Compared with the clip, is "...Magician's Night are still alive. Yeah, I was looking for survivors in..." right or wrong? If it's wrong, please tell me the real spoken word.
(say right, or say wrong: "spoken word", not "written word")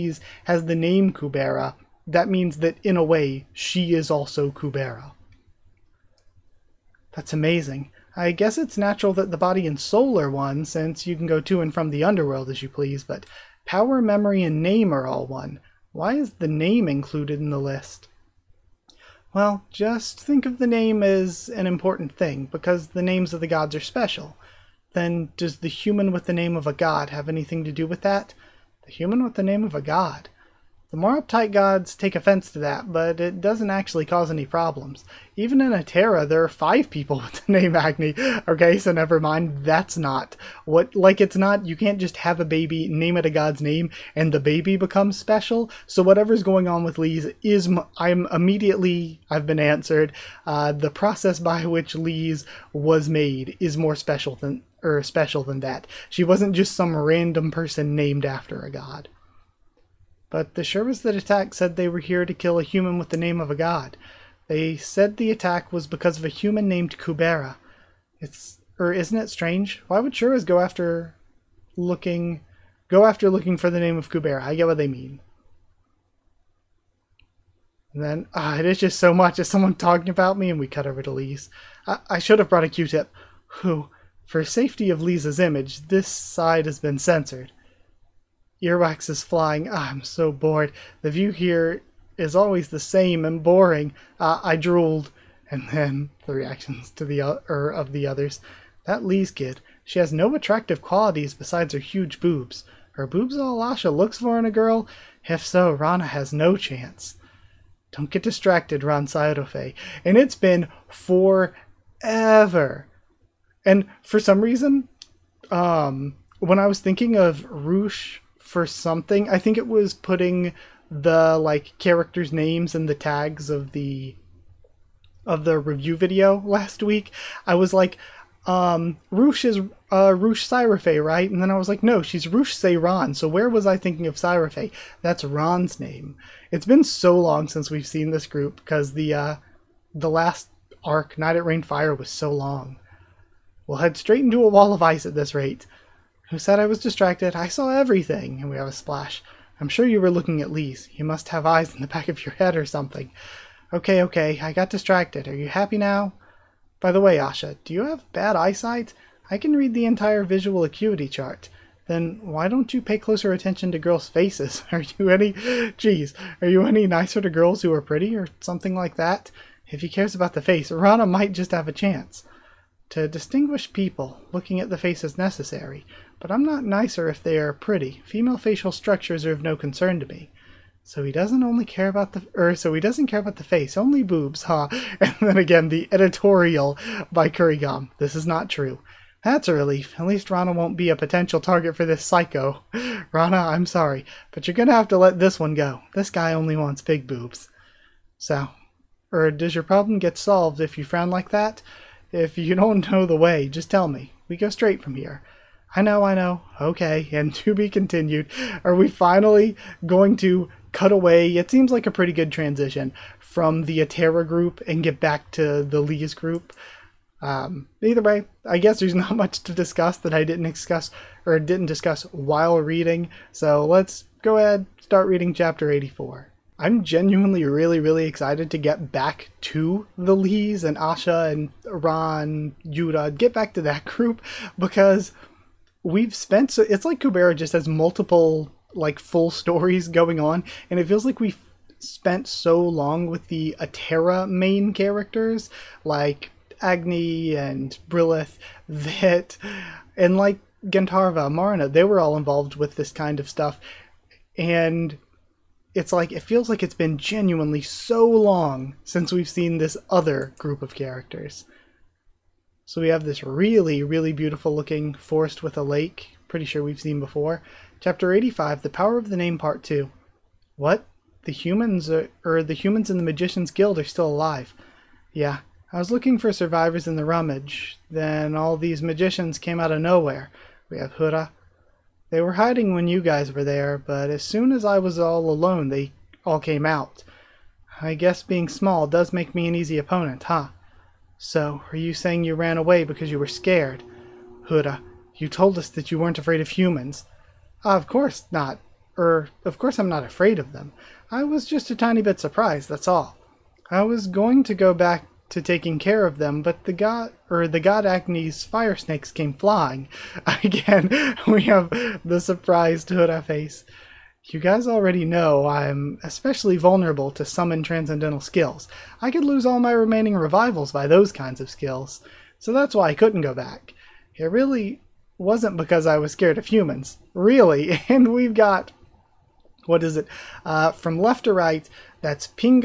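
wrong: "Guild", not "Night".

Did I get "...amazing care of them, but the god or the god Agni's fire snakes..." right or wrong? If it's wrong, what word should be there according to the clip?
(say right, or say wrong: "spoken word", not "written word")
wrong: "taking", not "amazing".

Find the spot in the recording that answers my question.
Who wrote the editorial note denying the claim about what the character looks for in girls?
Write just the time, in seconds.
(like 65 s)
187 s.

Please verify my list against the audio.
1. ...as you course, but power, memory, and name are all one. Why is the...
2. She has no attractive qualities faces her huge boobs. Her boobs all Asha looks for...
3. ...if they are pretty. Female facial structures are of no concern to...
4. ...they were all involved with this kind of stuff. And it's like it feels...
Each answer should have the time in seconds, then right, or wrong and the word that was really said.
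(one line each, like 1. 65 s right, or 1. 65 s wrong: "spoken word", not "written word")
1. 12 s wrong: "please", not "course"
2. 99 s wrong: "besides", not "faces"
3. 177 s right
4. 251 s right.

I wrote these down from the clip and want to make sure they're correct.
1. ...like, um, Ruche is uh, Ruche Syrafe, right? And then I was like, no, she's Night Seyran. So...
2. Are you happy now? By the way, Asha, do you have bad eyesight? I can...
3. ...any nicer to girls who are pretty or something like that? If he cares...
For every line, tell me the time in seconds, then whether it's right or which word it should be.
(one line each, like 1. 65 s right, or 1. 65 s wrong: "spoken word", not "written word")
1. 127 s wrong: "Ruche", not "Night"
2. 155 s right
3. 166 s right.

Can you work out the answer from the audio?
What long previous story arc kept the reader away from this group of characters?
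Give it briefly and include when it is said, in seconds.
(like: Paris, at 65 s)
Night at Rainfire, at 141 s.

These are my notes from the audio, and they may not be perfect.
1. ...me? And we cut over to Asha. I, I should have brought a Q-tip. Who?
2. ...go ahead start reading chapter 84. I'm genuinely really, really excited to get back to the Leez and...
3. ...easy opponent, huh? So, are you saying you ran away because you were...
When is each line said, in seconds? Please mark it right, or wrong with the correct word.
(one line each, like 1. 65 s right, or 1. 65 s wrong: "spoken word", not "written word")
1. 80 s wrong: "Leez", not "Asha"
2. 224 s right
3. 289 s right.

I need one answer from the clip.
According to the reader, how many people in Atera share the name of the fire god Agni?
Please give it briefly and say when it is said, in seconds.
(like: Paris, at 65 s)
5, at 36 s.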